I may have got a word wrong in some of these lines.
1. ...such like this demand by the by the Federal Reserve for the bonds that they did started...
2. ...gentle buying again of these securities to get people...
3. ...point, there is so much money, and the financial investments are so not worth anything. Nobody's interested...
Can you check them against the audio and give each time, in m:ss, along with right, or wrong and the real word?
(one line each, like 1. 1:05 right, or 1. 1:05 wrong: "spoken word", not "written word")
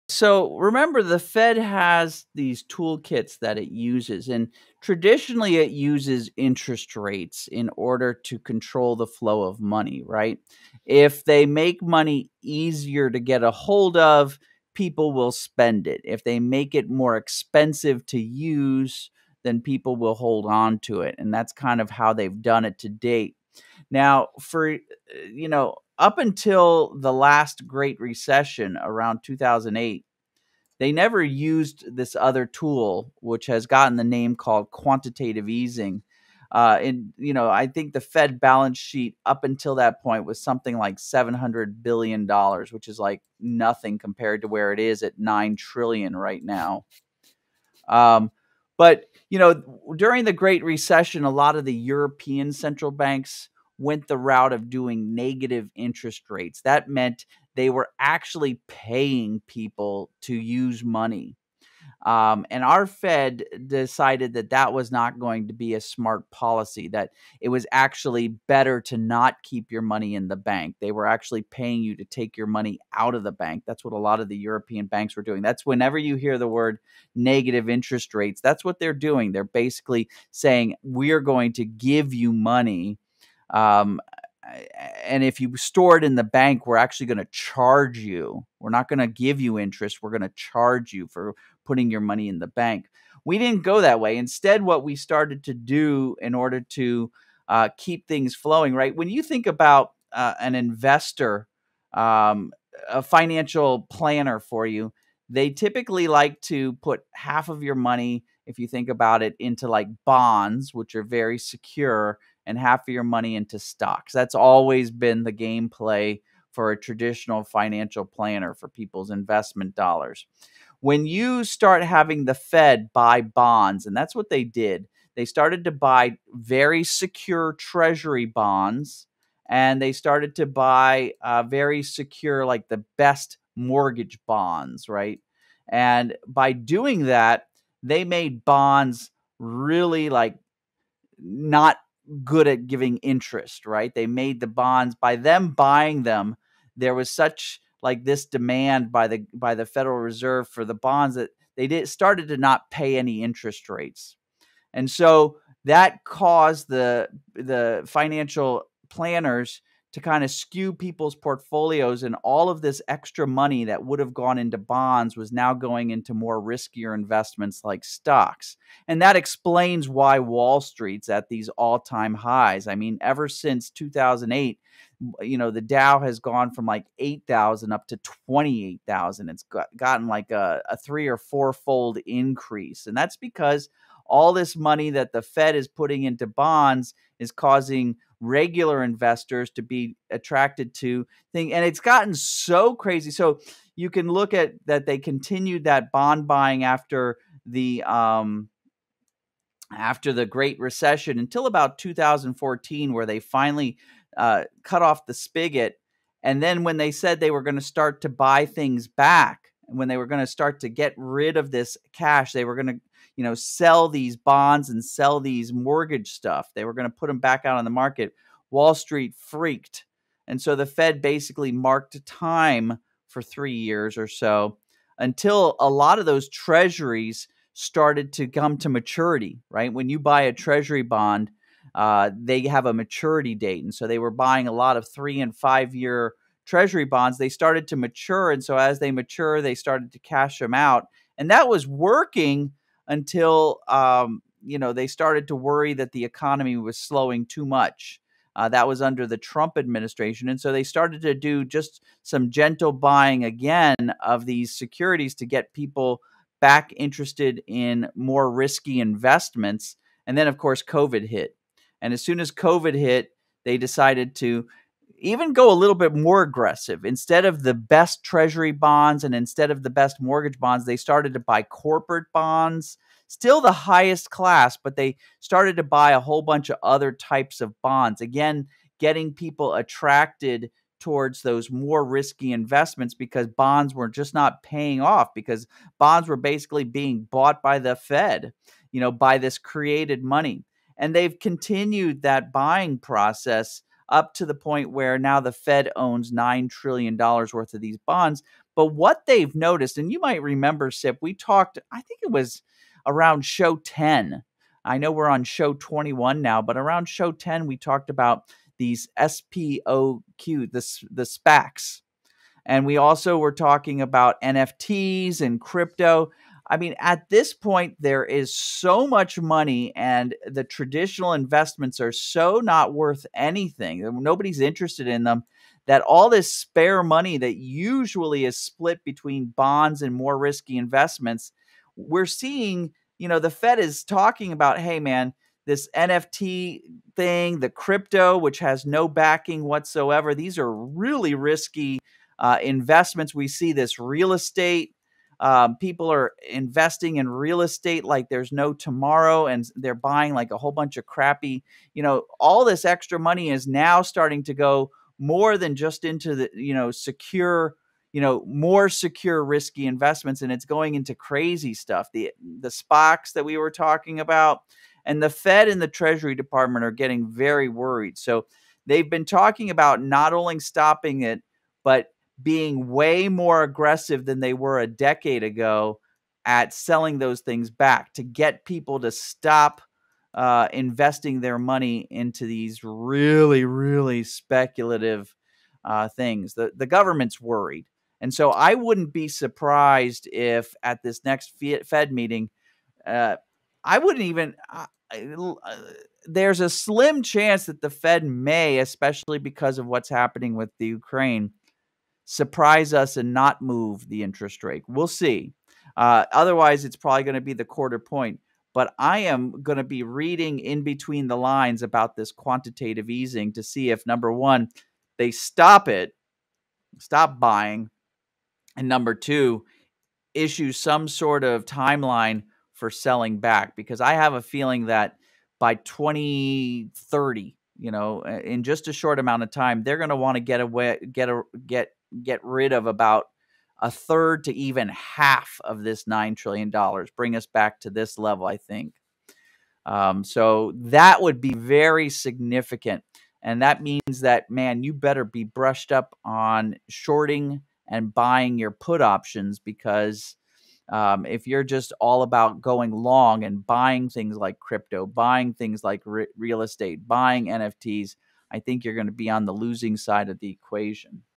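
1. 2:27 right
2. 4:12 right
3. 5:17 wrong: "traditional", not "financial".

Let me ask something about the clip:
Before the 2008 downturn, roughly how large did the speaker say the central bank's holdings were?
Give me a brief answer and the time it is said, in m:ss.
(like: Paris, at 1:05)
$700 billion, at 0:40.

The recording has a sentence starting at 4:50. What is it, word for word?
And they've continued that buying process up to the point where now the Fed owns $9 trillion worth of these bonds.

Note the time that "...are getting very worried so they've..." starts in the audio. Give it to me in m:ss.
6:06.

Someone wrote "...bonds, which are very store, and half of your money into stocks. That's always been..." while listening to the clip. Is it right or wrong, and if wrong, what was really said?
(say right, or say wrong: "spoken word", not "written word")
wrong: "secure", not "store".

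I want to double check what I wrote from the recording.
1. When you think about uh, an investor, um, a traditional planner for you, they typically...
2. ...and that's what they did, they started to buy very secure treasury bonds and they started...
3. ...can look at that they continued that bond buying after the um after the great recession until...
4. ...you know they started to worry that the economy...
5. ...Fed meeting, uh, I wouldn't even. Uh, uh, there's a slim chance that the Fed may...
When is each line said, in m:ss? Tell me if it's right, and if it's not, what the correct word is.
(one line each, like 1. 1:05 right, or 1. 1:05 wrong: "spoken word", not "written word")
1. 1:38 wrong: "financial", not "traditional"
2. 2:03 right
3. 3:13 right
4. 4:04 right
5. 6:31 right.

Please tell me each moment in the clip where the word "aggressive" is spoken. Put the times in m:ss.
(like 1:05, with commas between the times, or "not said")
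4:26, 6:13.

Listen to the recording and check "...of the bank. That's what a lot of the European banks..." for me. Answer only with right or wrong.
right.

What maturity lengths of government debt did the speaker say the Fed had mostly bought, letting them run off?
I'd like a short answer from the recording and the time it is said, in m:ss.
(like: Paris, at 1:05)
3 and 5 year, at 3:54.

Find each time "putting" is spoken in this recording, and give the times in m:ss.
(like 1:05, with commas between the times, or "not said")
1:31, 3:05.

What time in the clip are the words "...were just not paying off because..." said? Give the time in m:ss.
4:43.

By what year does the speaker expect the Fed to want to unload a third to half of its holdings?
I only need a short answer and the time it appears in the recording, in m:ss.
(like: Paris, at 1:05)
2030, at 7:05.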